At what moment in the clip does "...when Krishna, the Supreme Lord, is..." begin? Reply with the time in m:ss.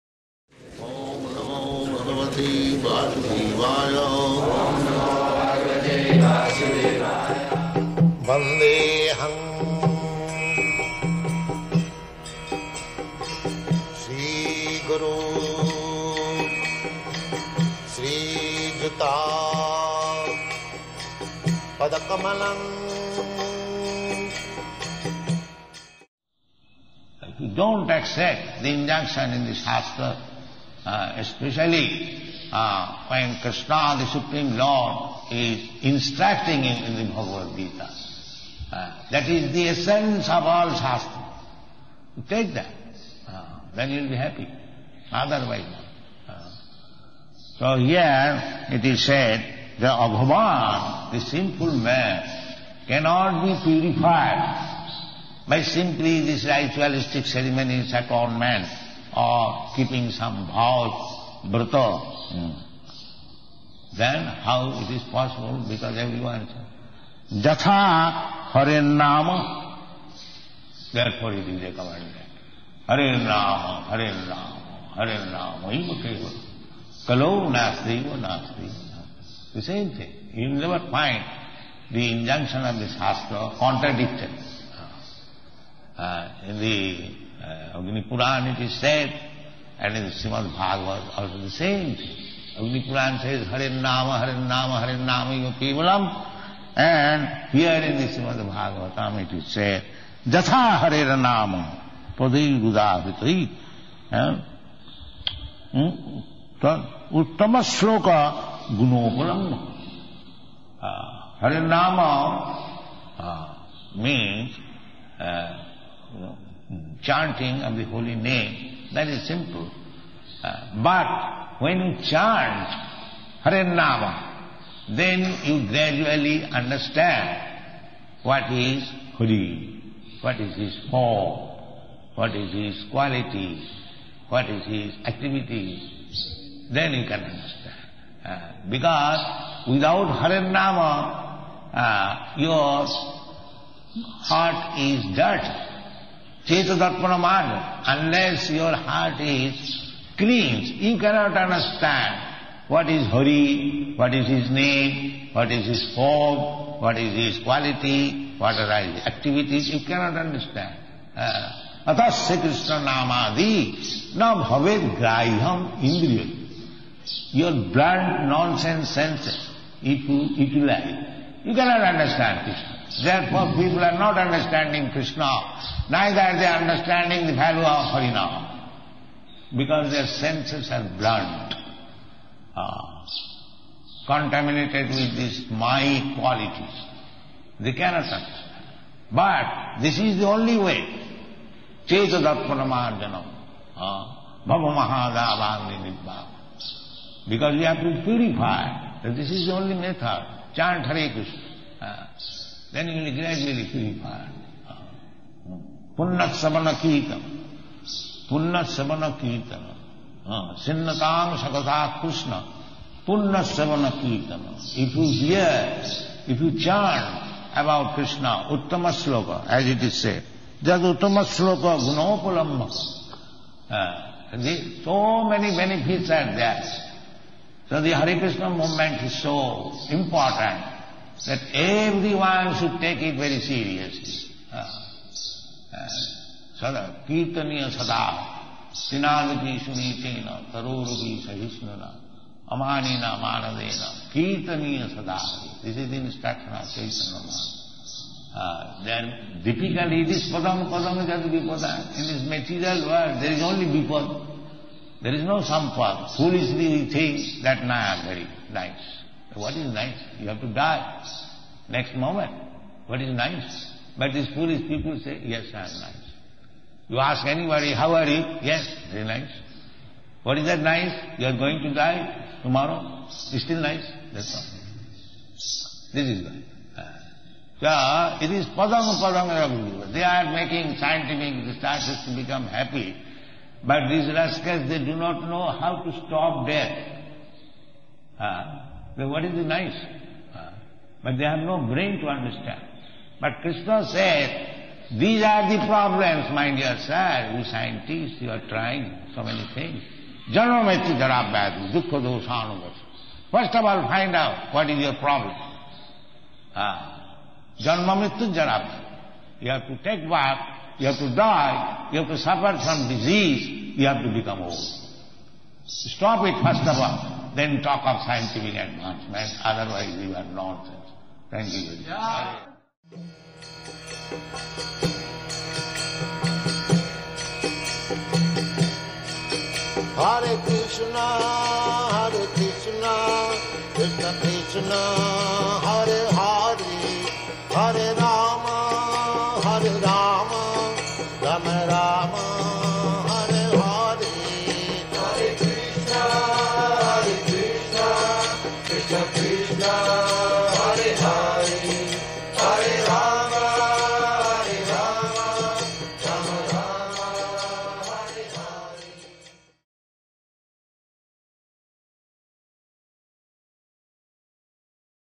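0:33.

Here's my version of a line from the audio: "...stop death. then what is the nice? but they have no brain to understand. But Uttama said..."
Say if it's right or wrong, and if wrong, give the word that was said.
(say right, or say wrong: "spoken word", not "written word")
wrong: "Krishna", not "Uttama".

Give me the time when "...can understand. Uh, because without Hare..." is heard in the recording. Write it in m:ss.
2:17.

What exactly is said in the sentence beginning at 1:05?
Because everyone is Jatha Hare Nama.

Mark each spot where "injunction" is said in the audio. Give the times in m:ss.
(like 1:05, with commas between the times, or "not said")
1:22.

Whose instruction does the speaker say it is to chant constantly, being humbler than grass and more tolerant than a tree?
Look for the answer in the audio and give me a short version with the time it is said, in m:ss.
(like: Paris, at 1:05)
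Chaitanya Mahaprabhu, at 4:06.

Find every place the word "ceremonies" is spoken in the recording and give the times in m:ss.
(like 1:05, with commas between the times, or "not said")
0:57.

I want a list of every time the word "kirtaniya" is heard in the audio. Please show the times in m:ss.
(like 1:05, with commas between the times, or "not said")
3:57, 4:04.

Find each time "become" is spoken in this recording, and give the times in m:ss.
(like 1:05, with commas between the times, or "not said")
4:42, 5:14.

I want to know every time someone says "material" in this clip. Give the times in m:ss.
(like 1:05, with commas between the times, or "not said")
4:12.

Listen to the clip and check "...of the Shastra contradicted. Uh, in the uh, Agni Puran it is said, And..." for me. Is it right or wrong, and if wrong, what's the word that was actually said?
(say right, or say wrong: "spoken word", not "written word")
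right.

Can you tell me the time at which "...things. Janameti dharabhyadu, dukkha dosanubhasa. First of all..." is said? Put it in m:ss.
4:59.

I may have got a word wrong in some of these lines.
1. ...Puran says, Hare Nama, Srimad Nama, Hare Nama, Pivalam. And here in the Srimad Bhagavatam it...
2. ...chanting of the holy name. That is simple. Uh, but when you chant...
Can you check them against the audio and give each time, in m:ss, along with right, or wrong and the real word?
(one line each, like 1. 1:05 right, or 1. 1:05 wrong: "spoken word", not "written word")
1. 1:32 wrong: "Hare", not "Srimad"
2. 1:57 right.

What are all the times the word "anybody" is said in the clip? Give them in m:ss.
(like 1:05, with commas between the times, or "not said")
4:27.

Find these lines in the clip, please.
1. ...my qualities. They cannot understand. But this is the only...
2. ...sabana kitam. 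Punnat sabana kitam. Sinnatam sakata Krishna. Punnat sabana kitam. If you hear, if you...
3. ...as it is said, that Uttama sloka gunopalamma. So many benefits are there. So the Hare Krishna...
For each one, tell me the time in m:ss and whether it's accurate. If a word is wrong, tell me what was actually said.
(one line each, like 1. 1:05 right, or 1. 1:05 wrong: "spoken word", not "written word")
1. 3:05 right
2. 3:26 right
3. 3:39 right.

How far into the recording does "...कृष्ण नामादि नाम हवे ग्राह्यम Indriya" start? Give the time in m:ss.
2:42.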